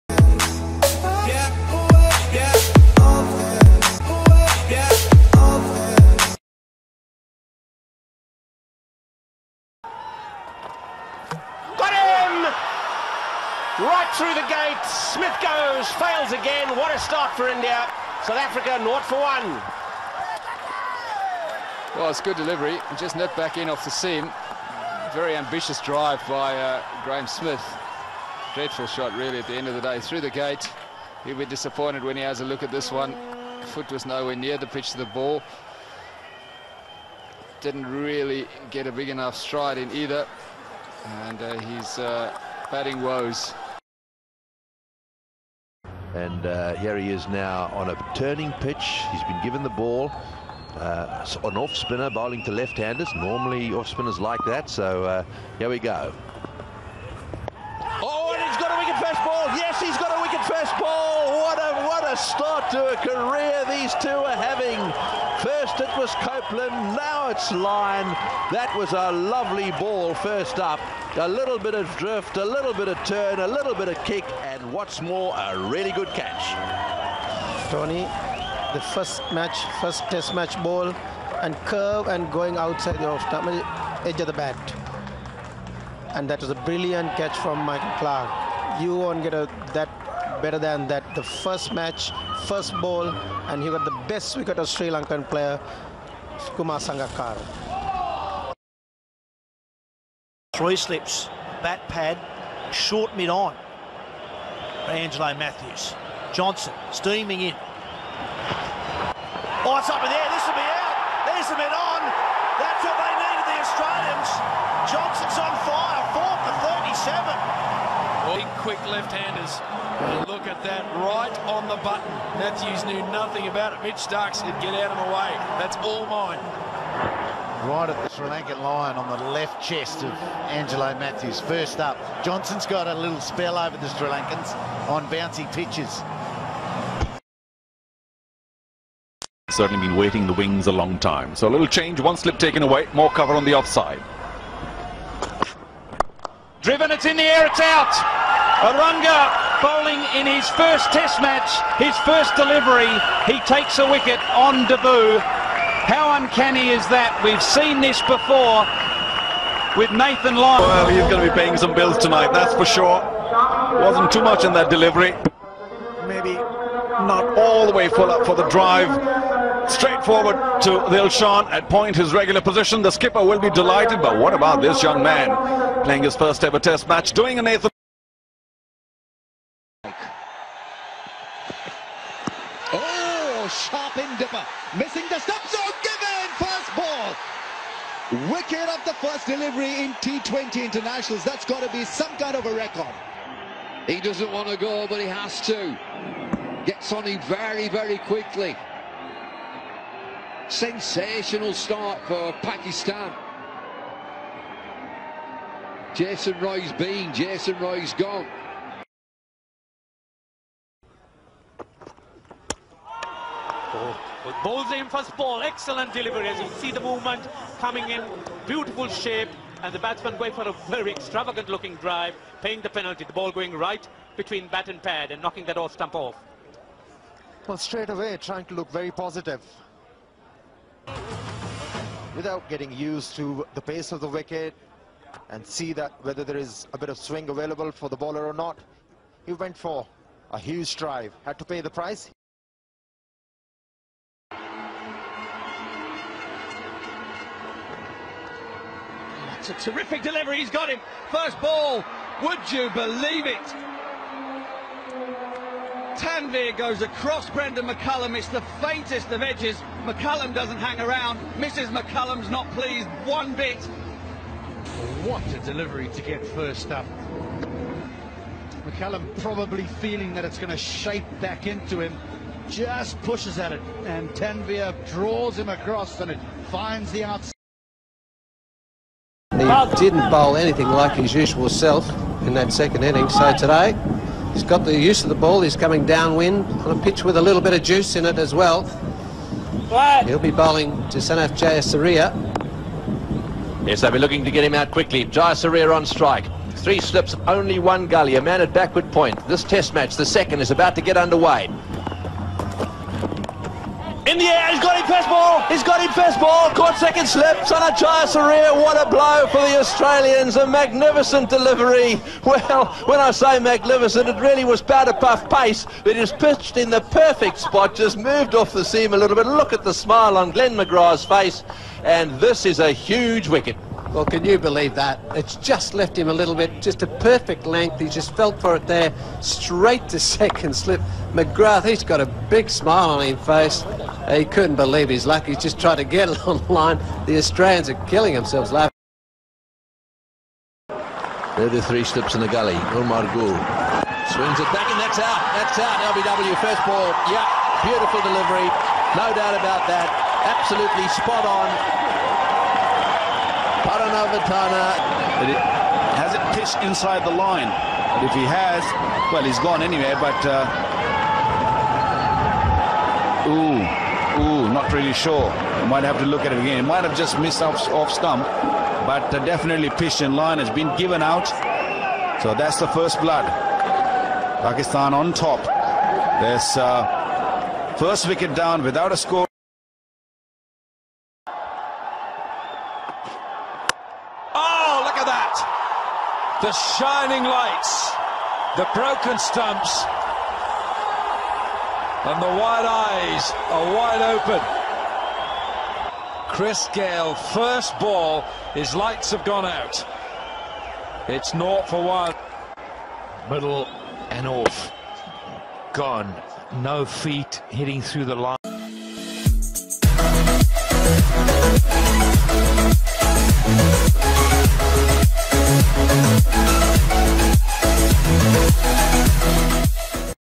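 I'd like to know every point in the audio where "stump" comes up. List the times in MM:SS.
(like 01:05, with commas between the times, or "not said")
03:45, 06:07, 06:29.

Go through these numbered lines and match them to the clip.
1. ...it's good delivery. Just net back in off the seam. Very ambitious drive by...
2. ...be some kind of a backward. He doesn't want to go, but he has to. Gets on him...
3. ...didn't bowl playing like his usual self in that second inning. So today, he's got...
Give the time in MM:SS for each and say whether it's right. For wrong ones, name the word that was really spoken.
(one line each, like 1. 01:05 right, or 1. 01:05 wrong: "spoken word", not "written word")
1. 00:22 right
2. 03:11 wrong: "record", not "backward"
3. 04:39 wrong: "anything", not "playing".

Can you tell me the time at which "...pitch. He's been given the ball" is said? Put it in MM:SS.
00:48.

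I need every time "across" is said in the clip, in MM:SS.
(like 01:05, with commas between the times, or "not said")
04:16, 04:35.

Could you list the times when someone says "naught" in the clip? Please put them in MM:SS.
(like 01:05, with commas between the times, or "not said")
00:18, 06:41.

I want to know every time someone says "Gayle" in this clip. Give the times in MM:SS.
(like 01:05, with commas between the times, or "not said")
06:36.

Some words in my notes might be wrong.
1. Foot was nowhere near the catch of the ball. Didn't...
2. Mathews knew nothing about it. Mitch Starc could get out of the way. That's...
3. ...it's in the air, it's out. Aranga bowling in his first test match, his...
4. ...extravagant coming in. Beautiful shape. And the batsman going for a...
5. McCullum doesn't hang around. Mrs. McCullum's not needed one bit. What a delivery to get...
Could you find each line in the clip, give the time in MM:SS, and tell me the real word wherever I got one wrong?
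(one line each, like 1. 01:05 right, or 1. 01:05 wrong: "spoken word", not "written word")
1. 00:33 wrong: "pitch", not "catch"
2. 02:02 right
3. 02:26 right
4. 03:36 wrong: "movement", not "extravagant"
5. 04:19 wrong: "pleased", not "needed".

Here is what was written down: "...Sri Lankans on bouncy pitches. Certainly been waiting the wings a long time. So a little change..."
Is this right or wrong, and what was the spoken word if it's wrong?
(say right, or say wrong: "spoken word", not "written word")
right.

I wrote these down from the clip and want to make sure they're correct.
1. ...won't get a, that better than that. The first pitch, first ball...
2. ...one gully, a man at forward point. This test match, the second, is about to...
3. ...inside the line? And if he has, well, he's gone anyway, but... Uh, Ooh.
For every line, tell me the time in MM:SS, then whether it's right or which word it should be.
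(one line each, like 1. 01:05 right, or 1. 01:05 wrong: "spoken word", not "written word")
1. 01:28 wrong: "match", not "pitch"
2. 04:57 wrong: "backward", not "forward"
3. 05:56 right.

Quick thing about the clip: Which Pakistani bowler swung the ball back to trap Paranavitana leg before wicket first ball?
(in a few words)
Umar Gul.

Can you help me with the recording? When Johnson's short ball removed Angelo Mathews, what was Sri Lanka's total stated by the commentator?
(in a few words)
4 for 37.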